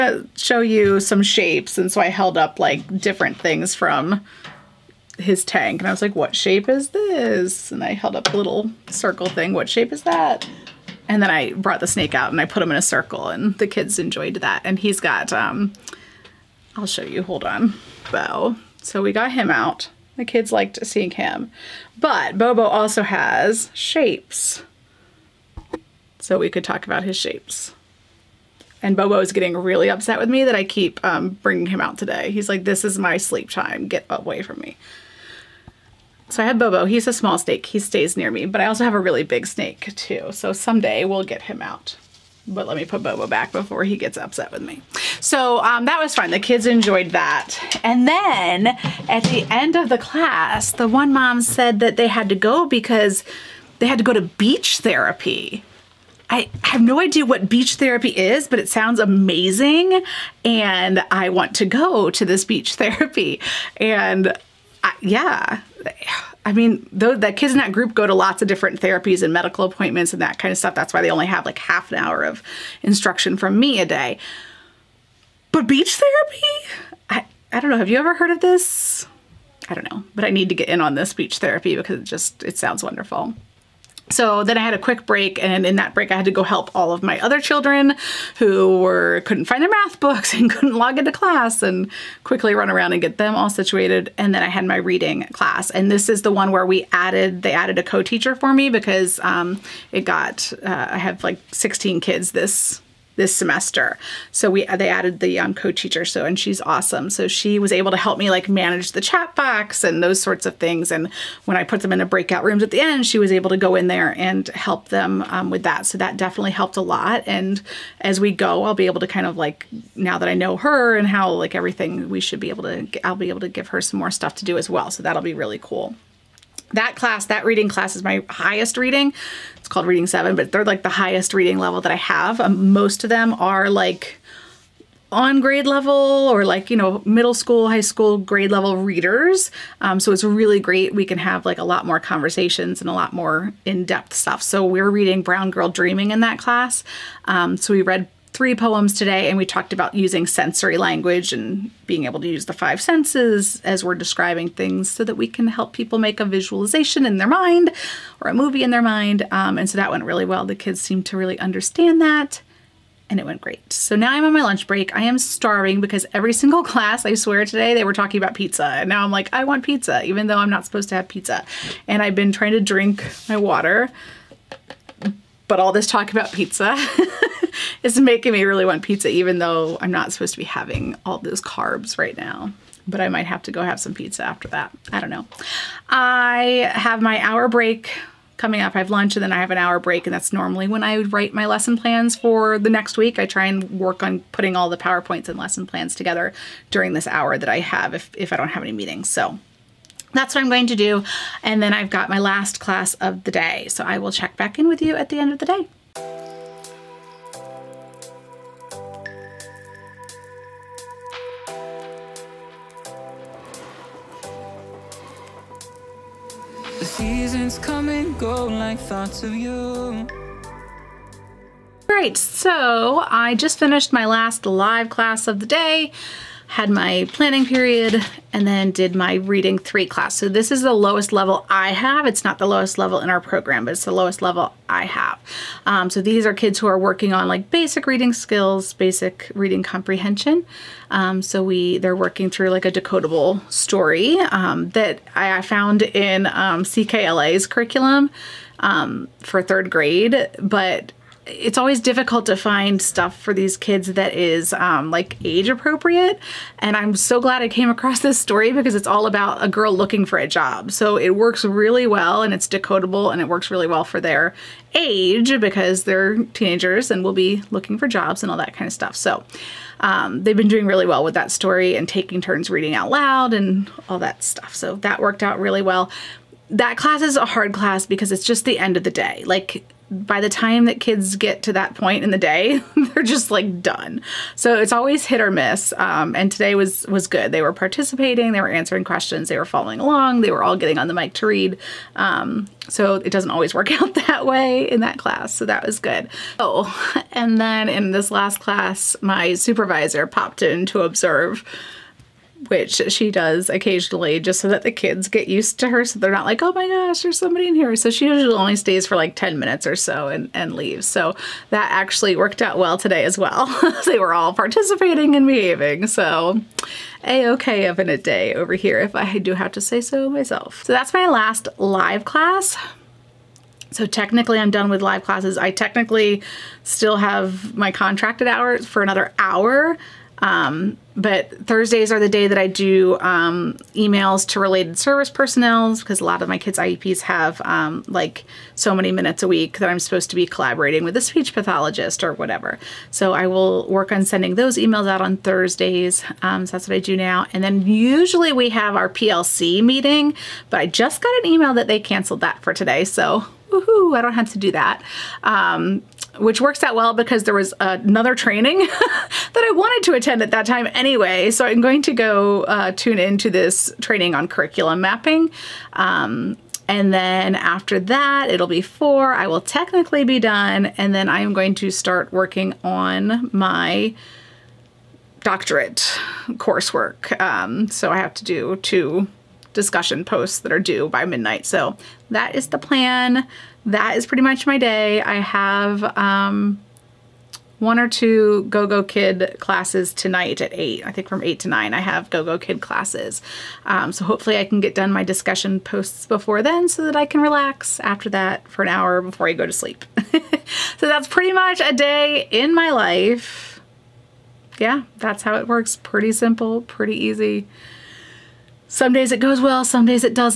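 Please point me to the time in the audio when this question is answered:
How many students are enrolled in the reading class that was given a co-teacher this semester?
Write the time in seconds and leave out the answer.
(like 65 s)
101 s.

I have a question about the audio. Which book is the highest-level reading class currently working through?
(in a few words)
Brown Girl Dreaming.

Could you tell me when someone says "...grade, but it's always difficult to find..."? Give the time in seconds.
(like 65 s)
249 s.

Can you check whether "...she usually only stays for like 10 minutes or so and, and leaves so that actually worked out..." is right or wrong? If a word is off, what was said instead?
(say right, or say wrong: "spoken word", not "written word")
right.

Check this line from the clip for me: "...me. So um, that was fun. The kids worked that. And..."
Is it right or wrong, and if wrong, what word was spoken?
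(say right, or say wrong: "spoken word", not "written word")
wrong: "enjoyed", not "worked".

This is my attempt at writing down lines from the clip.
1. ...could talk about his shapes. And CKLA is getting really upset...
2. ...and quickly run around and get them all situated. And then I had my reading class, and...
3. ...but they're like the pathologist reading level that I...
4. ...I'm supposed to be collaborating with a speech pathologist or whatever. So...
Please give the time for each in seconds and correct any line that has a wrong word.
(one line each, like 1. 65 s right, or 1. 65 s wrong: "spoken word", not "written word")
1. 26 s wrong: "Bobo", not "CKLA"
2. 91 s right
3. 130 s wrong: "highest", not "pathologist"
4. 339 s right.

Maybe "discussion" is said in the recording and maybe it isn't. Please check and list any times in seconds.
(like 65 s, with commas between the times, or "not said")
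379 s, 395 s.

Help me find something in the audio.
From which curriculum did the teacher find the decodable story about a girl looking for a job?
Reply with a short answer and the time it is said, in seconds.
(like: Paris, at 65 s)
CKLA, at 246 s.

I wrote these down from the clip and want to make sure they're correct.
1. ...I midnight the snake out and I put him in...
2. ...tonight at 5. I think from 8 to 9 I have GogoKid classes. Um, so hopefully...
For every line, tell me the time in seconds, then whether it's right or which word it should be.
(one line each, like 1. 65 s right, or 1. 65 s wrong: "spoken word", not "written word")
1. 11 s wrong: "brought", not "midnight"
2. 389 s wrong: "8", not "5".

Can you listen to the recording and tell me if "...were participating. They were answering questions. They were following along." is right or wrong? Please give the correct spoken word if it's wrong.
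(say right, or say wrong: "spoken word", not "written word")
right.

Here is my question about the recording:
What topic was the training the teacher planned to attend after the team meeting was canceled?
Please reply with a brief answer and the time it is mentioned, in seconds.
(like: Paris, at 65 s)
curriculum mapping, at 364 s.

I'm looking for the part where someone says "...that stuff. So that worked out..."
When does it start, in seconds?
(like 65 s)
273 s.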